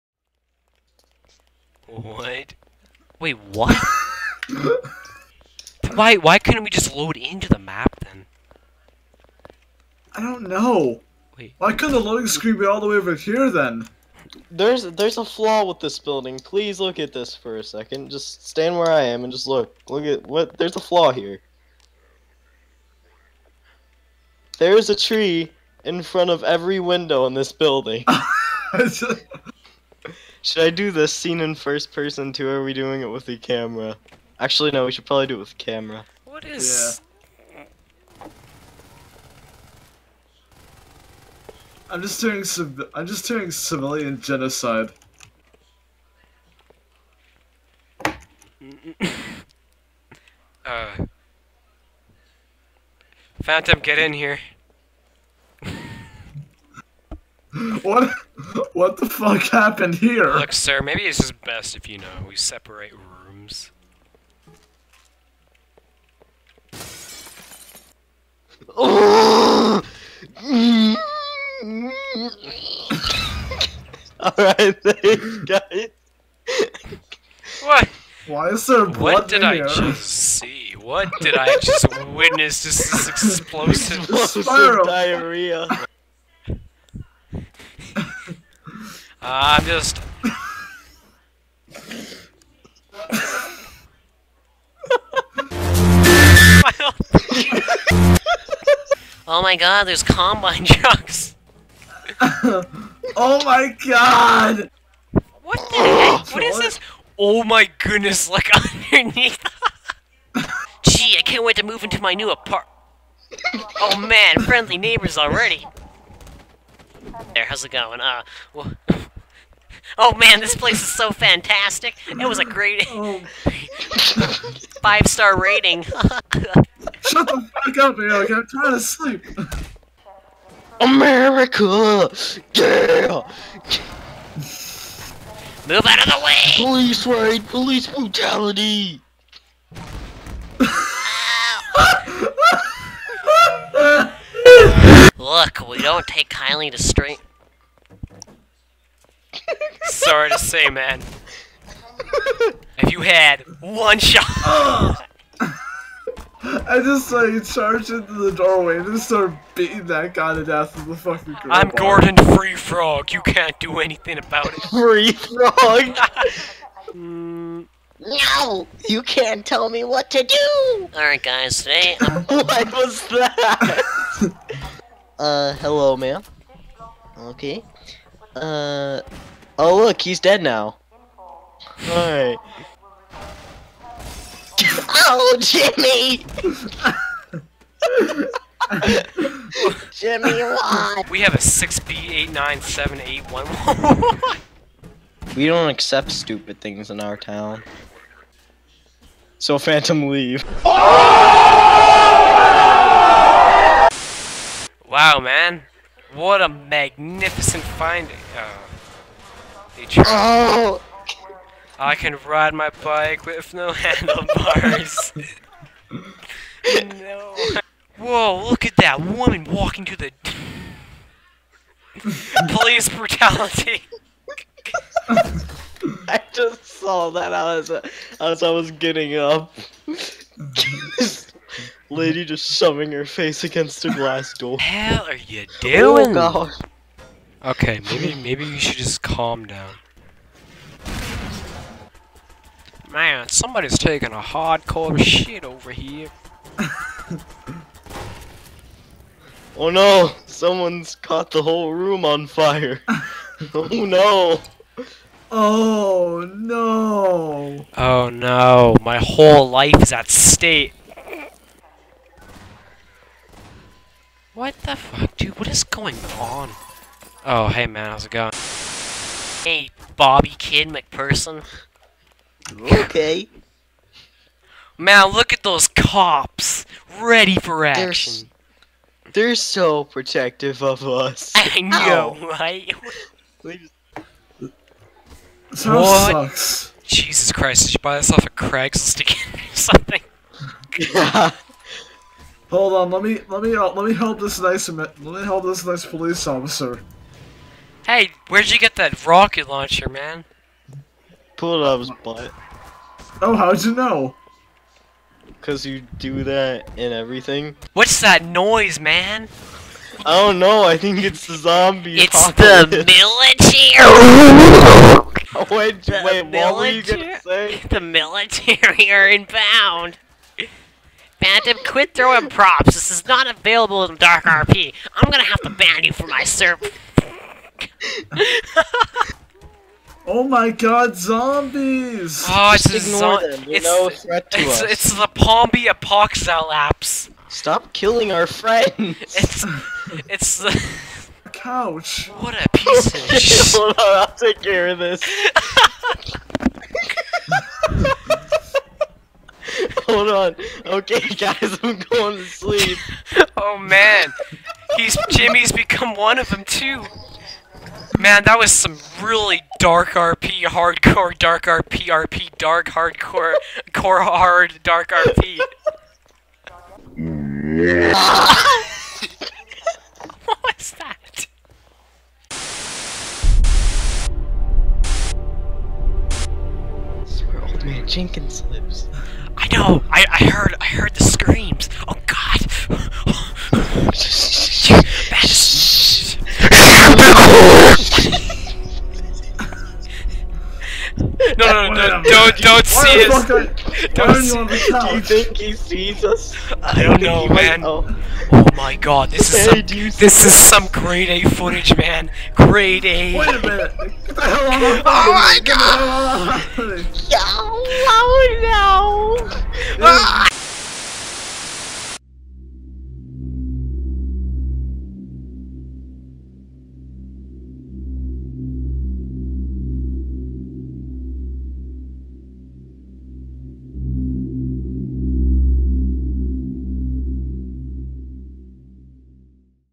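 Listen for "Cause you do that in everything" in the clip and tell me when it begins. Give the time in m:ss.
5:05.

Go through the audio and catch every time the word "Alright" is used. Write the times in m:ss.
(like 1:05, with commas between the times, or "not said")
1:08, 2:50, 3:01.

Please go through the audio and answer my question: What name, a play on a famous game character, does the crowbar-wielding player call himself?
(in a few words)
Gordon Free Frog.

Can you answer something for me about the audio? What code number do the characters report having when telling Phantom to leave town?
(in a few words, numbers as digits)
6B897811.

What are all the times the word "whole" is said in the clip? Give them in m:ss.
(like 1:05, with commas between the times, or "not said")
4:11, 4:18.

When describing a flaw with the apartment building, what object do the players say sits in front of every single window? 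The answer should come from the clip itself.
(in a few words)
A tree.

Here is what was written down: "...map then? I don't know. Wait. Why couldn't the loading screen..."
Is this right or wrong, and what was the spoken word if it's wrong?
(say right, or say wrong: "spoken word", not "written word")
right.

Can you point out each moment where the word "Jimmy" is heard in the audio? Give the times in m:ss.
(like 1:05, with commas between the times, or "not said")
3:05, 3:09, 5:55.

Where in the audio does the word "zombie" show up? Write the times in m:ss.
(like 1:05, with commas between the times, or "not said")
5:11, 5:30.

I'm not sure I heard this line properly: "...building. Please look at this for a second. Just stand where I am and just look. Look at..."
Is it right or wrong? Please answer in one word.
right.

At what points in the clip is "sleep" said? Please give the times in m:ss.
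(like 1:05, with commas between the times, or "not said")
2:08, 5:52.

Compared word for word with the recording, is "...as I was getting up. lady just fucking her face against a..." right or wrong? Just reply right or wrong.
wrong.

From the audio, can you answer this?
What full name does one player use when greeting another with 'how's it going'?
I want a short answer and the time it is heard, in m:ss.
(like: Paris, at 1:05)
Bobby Kid McPherson, at 4:29.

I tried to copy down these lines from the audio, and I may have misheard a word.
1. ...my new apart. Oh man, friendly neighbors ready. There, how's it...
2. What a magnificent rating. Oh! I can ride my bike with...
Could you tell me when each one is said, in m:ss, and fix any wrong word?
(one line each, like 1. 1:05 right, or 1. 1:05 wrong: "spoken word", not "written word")
1. 1:52 wrong: "already", not "ready"
2. 3:26 wrong: "finding", not "rating".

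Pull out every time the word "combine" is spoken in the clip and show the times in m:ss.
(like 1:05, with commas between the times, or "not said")
1:40.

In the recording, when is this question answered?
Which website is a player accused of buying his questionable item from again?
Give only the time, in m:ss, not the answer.
4:48.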